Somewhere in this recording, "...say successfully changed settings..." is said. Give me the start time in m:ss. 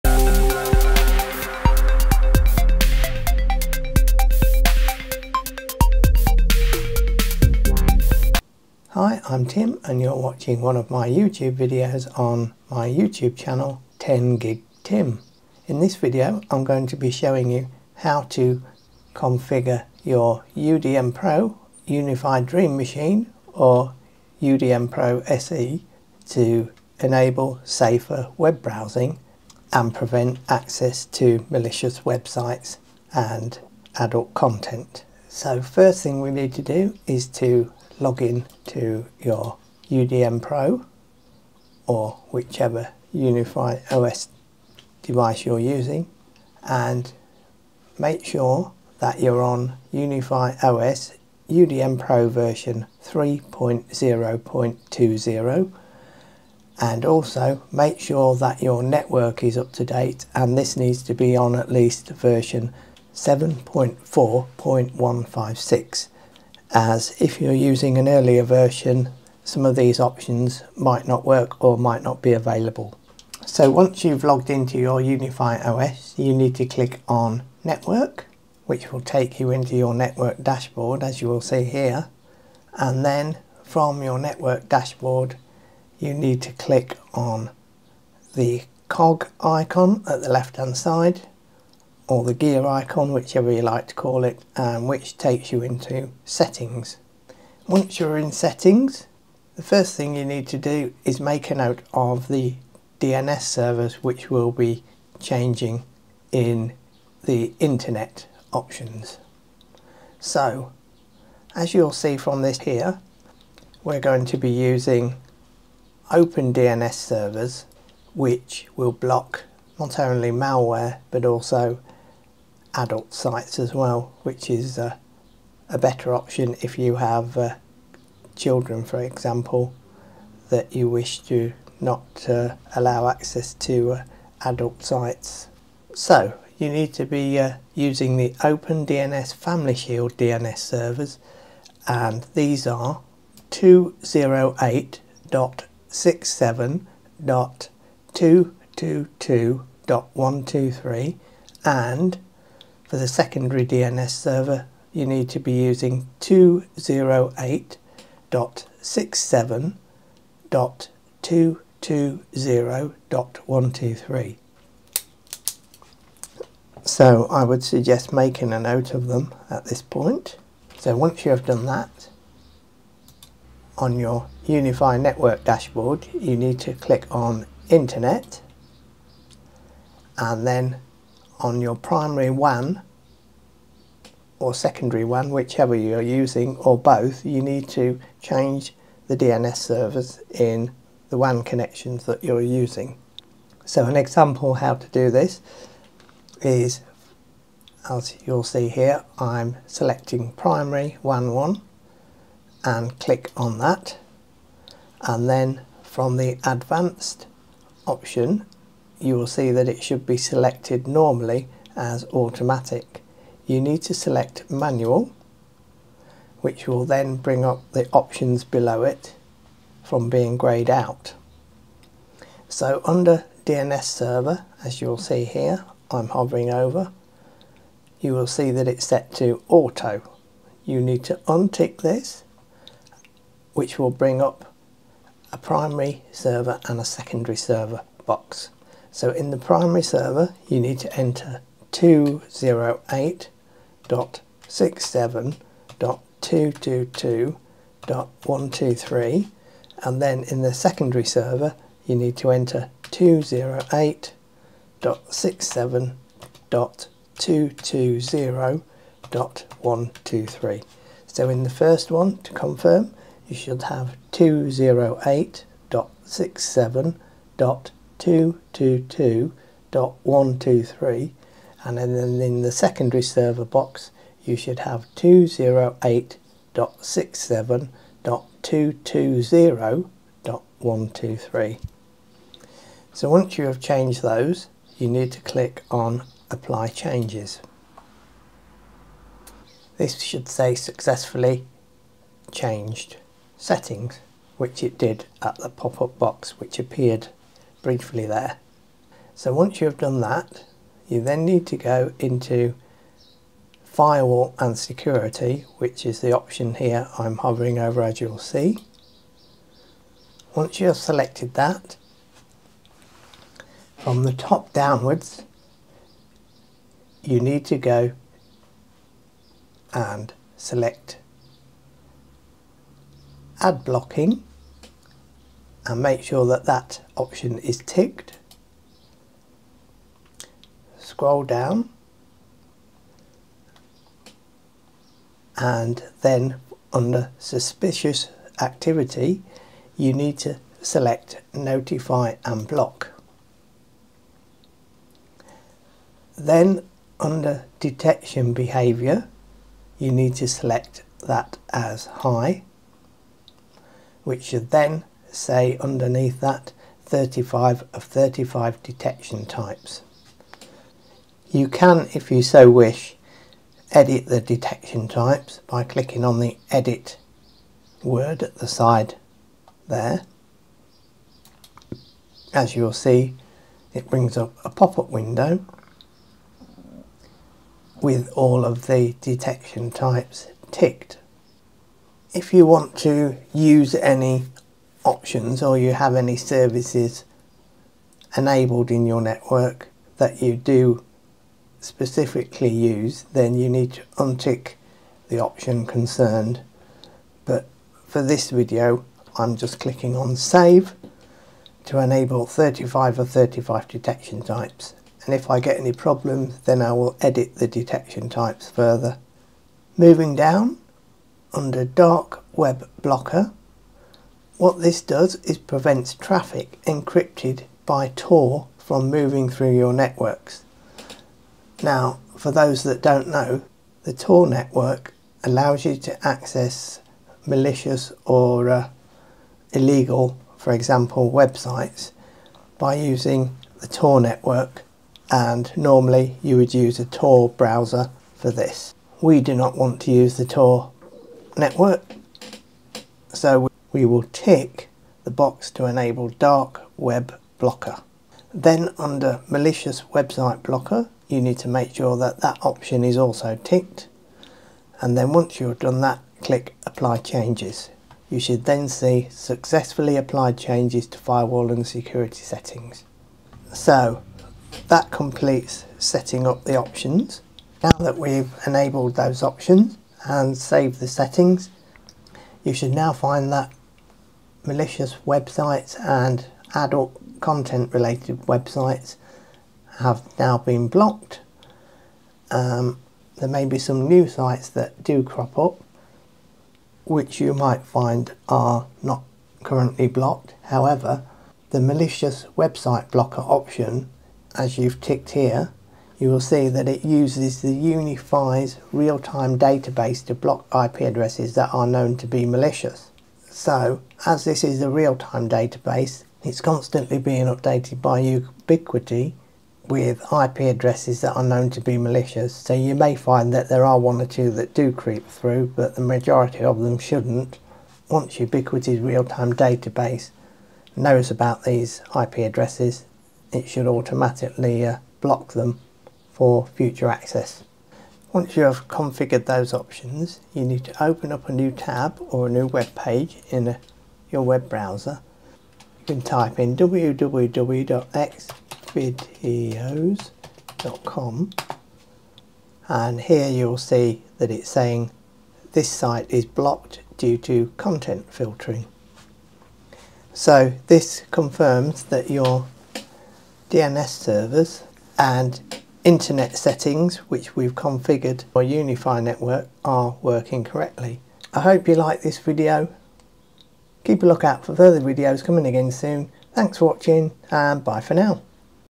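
4:50.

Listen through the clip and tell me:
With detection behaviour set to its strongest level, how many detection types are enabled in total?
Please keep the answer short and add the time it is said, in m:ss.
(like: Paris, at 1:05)
35, at 5:56.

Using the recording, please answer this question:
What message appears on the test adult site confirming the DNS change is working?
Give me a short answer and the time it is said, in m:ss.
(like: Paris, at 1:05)
blocked due to content filtering, at 9:06.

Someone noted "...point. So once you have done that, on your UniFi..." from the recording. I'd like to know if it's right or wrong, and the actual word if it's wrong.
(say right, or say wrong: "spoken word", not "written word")
right.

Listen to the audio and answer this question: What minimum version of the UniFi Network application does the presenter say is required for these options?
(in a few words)
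7.4.156.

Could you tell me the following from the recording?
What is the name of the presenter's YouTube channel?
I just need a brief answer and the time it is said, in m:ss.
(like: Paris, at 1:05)
10 Gig Tim, at 0:13.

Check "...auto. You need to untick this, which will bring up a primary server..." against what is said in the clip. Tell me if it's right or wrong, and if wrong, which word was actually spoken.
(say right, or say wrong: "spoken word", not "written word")
right.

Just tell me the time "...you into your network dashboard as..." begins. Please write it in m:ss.
1:19.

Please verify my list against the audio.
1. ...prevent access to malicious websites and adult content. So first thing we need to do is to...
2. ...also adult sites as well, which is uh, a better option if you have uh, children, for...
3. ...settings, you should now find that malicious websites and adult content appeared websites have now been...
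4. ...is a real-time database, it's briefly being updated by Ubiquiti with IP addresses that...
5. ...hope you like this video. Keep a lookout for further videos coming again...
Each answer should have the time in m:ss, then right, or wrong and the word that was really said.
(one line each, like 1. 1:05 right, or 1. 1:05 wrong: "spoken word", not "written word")
1. 0:29 right
2. 2:01 right
3. 7:50 wrong: "related", not "appeared"
4. 8:24 wrong: "constantly", not "briefly"
5. 9:21 right.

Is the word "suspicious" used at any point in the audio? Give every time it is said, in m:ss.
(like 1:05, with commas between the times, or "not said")
5:37.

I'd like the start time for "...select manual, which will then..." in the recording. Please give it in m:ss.
3:33.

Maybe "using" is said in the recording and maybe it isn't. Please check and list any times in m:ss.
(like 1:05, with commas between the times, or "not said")
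0:45, 1:07, 1:54, 2:17, 2:35, 3:06, 3:12, 7:12.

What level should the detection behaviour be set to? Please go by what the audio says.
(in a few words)
high.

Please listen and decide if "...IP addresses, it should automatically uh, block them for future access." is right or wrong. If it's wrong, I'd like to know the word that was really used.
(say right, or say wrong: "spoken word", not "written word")
right.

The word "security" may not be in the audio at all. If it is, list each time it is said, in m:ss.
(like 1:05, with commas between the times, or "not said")
5:04, 7:41.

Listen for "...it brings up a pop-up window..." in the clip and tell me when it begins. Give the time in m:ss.
6:13.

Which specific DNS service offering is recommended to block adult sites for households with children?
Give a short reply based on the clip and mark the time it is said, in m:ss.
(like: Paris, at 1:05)
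OpenDNS Family Shield, at 2:18.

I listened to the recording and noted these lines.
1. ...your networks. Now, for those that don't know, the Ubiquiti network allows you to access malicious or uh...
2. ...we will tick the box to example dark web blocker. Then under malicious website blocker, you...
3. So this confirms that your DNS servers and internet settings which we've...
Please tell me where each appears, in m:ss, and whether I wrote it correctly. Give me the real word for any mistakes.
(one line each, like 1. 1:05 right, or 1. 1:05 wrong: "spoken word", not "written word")
1. 6:59 wrong: "Tor", not "Ubiquiti"
2. 7:23 wrong: "enable", not "example"
3. 9:10 right.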